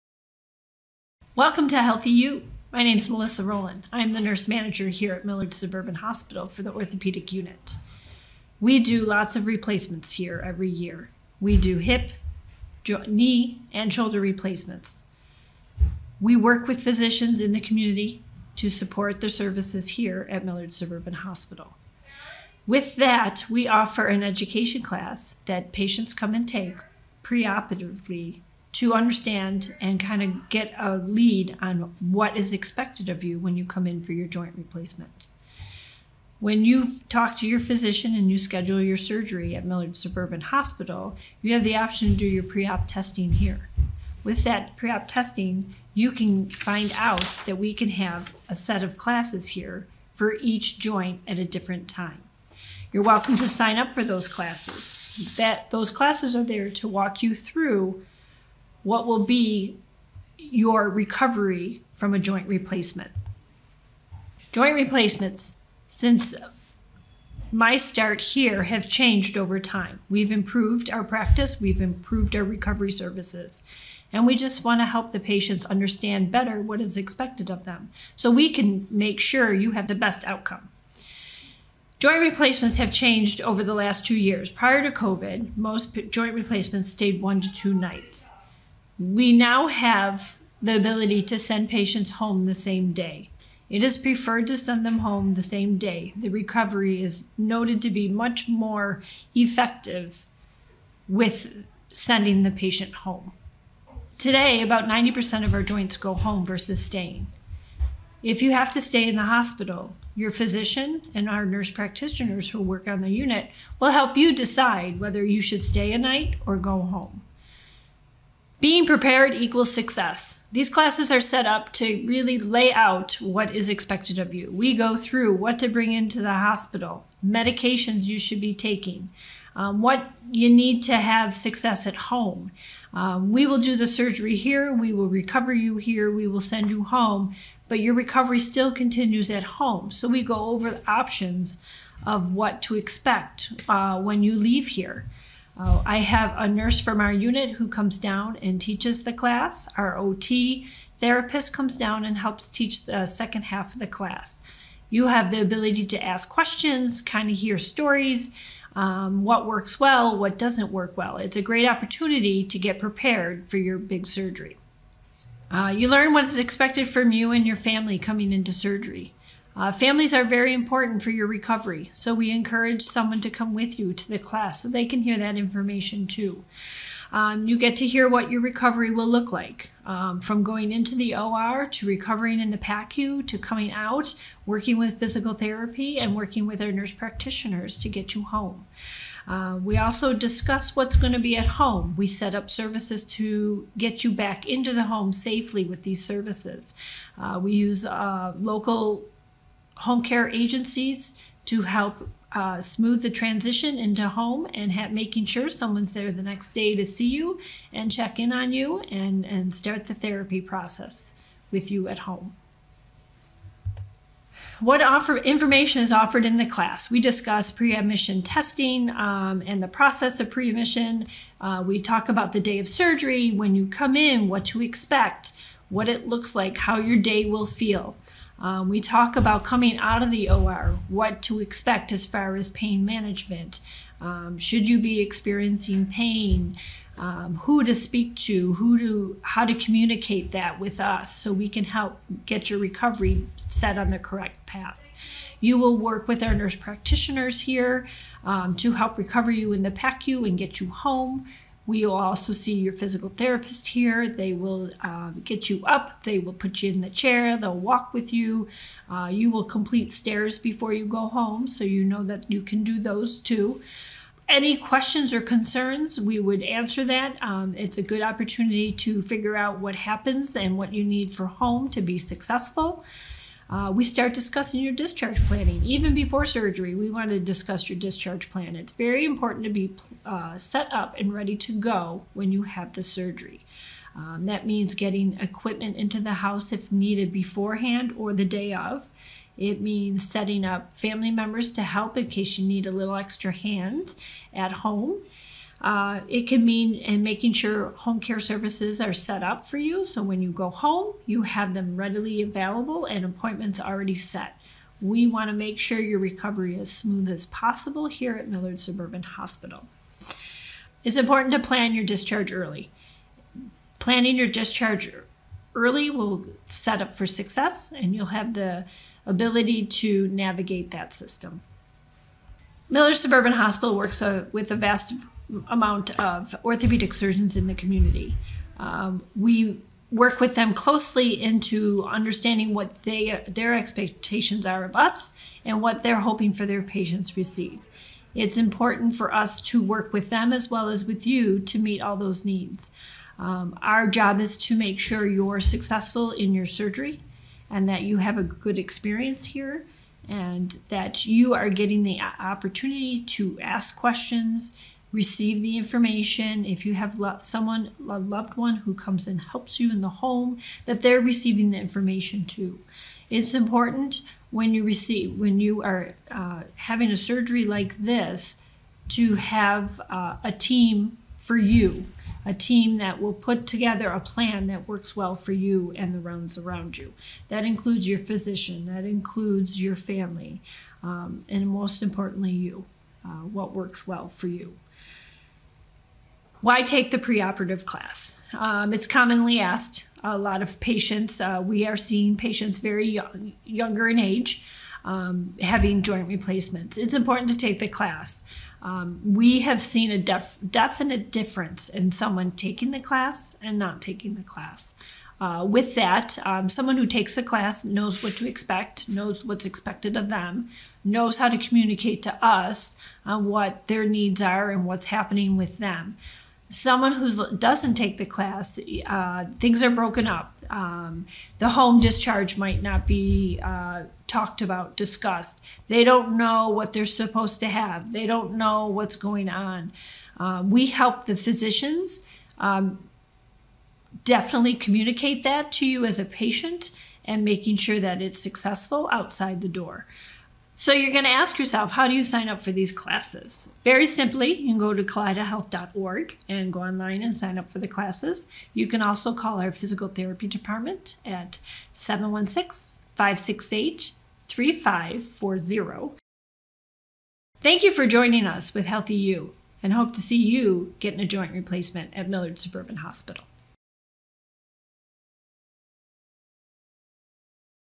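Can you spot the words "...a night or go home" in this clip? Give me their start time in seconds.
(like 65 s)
115 s.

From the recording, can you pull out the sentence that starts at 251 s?
We will also see your physical therapist here.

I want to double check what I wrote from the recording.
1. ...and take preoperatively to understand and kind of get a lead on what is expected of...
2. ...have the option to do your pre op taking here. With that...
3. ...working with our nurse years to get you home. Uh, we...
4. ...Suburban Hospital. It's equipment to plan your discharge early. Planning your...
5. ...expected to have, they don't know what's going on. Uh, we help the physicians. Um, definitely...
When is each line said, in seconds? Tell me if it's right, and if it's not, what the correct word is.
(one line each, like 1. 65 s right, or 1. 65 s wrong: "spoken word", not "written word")
1. 26 s right
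2. 41 s wrong: "testing", not "taking"
3. 186 s wrong: "practitioners", not "years"
4. 308 s wrong: "important", not "equipment"
5. 426 s wrong: "supposed", not "expected".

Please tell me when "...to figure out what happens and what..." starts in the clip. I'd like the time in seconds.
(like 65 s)
268 s.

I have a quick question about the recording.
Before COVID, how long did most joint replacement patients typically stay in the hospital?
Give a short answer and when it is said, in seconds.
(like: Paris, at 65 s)
1 to 2 nights, at 87 s.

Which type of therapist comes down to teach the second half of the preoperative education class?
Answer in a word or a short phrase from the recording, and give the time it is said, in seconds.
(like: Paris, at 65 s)
OT therapist, at 149 s.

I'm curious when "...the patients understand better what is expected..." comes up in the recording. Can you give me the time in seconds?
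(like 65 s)
75 s.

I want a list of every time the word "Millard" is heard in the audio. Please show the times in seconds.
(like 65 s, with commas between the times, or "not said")
5 s, 20 s, 39 s, 308 s, 322 s, 462 s.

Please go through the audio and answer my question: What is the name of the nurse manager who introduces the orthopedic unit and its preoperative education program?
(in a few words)
Melissa Rowland.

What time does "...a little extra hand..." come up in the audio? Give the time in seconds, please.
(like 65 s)
292 s.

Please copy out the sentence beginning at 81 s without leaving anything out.
Joint replacements have changed over the last two years.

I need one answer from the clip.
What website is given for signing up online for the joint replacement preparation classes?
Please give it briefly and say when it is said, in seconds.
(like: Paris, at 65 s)
kaleidahealth.org, at 444 s.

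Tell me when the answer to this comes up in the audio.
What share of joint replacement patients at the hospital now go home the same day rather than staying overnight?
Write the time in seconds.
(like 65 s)
104 s.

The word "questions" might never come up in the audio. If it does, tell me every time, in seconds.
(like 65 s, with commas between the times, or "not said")
156 s, 264 s, 353 s.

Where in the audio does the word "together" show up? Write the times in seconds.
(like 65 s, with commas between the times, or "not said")
373 s.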